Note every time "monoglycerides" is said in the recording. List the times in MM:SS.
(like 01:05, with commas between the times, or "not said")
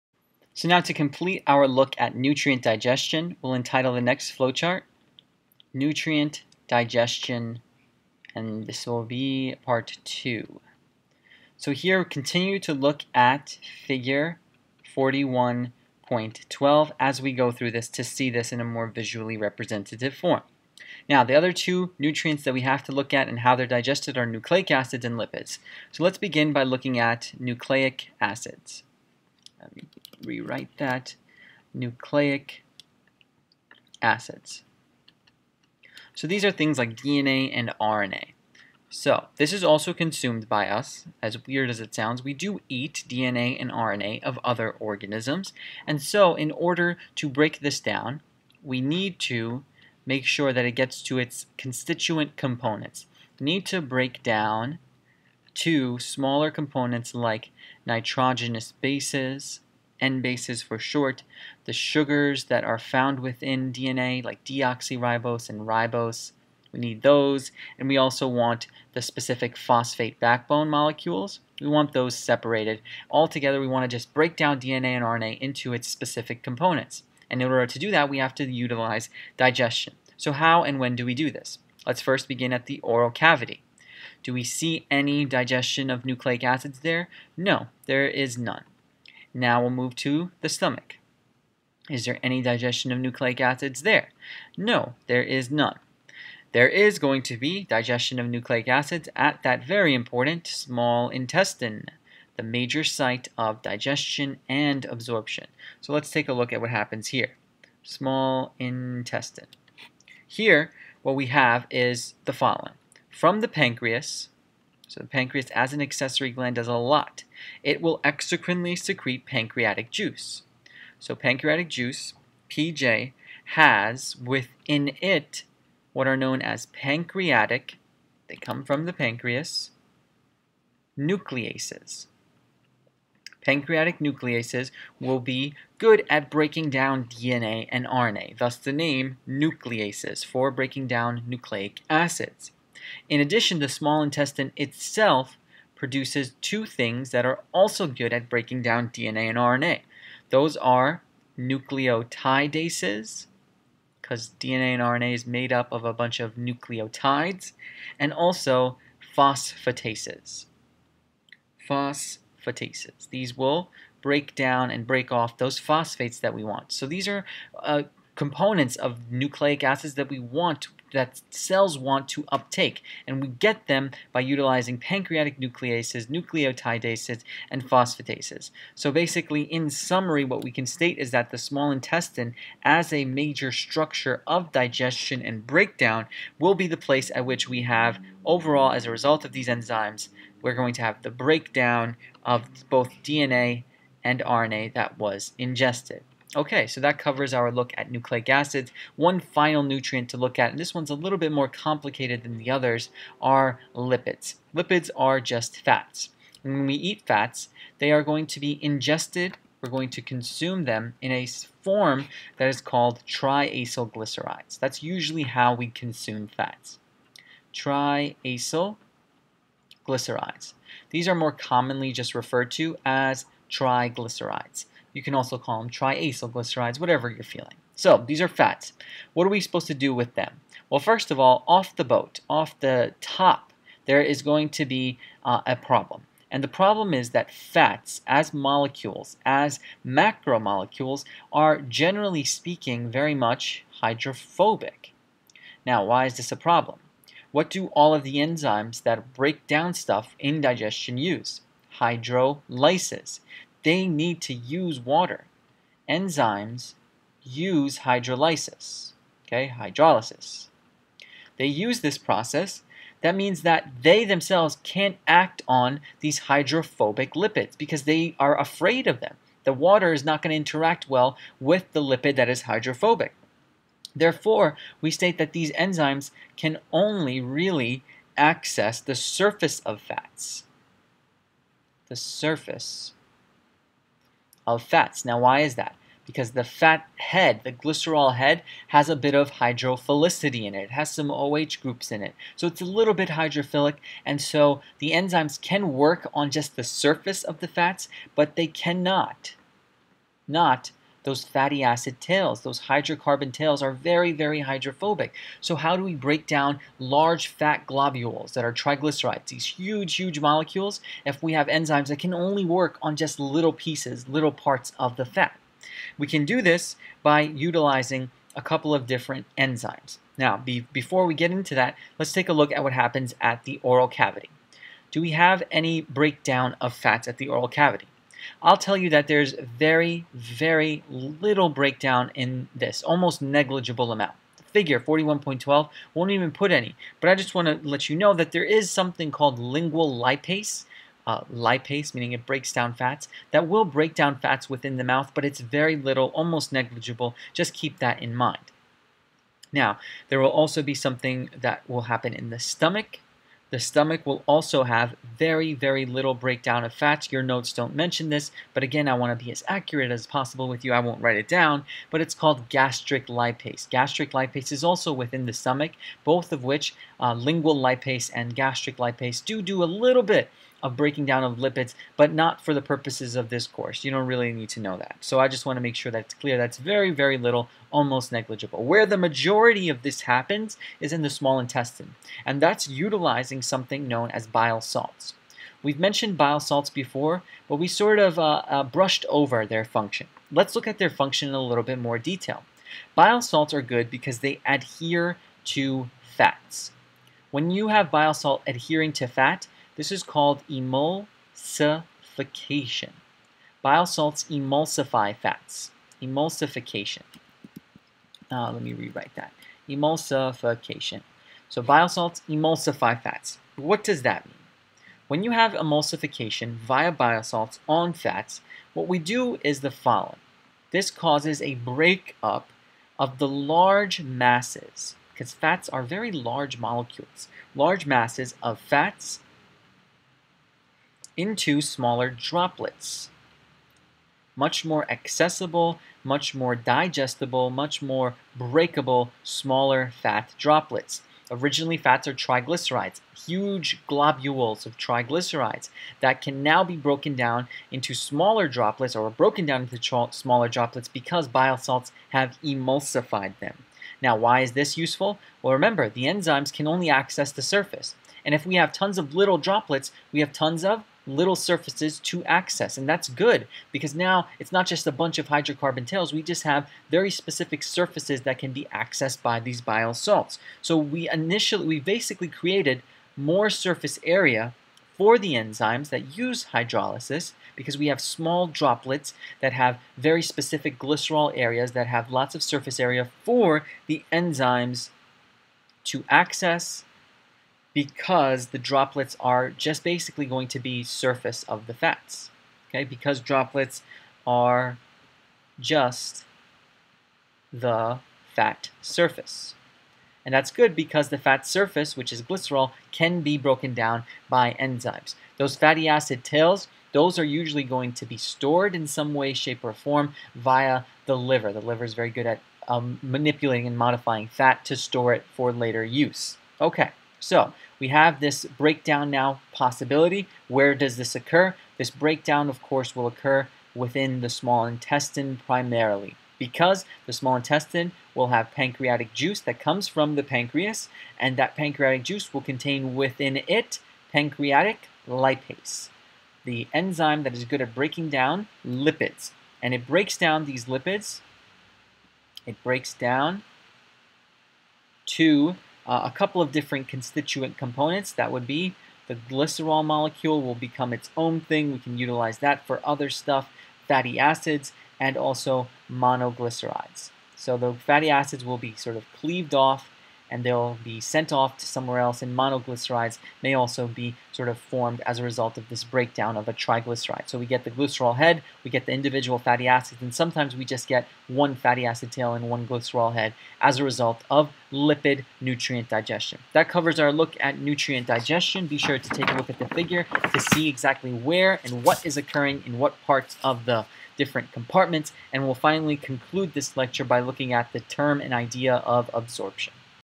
09:15, 09:22.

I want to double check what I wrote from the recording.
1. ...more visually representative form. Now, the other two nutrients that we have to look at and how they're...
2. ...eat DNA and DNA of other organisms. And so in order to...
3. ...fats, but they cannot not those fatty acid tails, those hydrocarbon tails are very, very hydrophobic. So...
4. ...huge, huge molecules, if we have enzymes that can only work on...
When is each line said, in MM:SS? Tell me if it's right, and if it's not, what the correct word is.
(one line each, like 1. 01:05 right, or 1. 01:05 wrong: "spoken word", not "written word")
1. 00:18 right
2. 00:42 wrong: "RNA", not "DNA"
3. 04:57 right
4. 05:09 right.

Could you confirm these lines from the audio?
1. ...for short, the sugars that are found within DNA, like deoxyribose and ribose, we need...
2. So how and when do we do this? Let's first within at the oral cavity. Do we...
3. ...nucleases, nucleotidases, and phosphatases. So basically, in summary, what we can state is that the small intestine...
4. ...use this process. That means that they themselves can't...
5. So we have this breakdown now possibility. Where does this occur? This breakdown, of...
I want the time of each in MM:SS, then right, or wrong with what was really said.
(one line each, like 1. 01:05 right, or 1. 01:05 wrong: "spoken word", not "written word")
1. 01:00 right
2. 01:20 wrong: "begin", not "within"
3. 02:55 right
4. 04:21 right
5. 08:37 right.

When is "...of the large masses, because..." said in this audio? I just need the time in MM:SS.
07:02.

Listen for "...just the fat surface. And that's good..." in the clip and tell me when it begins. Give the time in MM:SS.
08:15.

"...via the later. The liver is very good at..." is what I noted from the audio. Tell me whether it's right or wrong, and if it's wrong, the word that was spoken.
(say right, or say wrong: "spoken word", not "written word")
wrong: "liver", not "later".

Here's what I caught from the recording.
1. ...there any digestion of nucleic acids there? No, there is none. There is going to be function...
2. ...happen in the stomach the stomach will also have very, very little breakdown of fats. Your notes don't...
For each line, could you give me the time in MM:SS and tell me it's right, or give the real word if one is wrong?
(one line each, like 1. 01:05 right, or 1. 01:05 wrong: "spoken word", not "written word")
1. 01:32 wrong: "digestion", not "function"
2. 05:51 right.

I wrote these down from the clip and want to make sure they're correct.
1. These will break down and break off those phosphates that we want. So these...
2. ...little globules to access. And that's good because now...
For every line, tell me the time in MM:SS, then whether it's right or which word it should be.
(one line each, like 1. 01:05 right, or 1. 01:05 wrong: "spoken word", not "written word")
1. 02:43 right
2. 07:41 wrong: "surfaces", not "globules".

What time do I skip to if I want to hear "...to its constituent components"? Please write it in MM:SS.
00:51.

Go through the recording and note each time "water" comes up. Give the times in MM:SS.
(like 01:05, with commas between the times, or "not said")
04:14, 04:29.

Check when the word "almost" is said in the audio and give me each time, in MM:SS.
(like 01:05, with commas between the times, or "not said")
05:32, 05:46, 06:17.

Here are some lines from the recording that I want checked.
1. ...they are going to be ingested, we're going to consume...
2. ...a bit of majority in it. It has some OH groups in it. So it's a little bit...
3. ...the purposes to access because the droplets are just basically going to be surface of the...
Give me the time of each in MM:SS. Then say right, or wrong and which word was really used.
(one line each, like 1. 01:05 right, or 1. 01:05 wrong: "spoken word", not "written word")
1. 03:27 right
2. 04:48 wrong: "hydrophilicity", not "majority"
3. 08:03 wrong: "enzymes", not "purposes".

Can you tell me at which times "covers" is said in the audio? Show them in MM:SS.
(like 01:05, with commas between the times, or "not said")
03:16, 09:36.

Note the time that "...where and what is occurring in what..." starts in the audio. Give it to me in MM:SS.
09:41.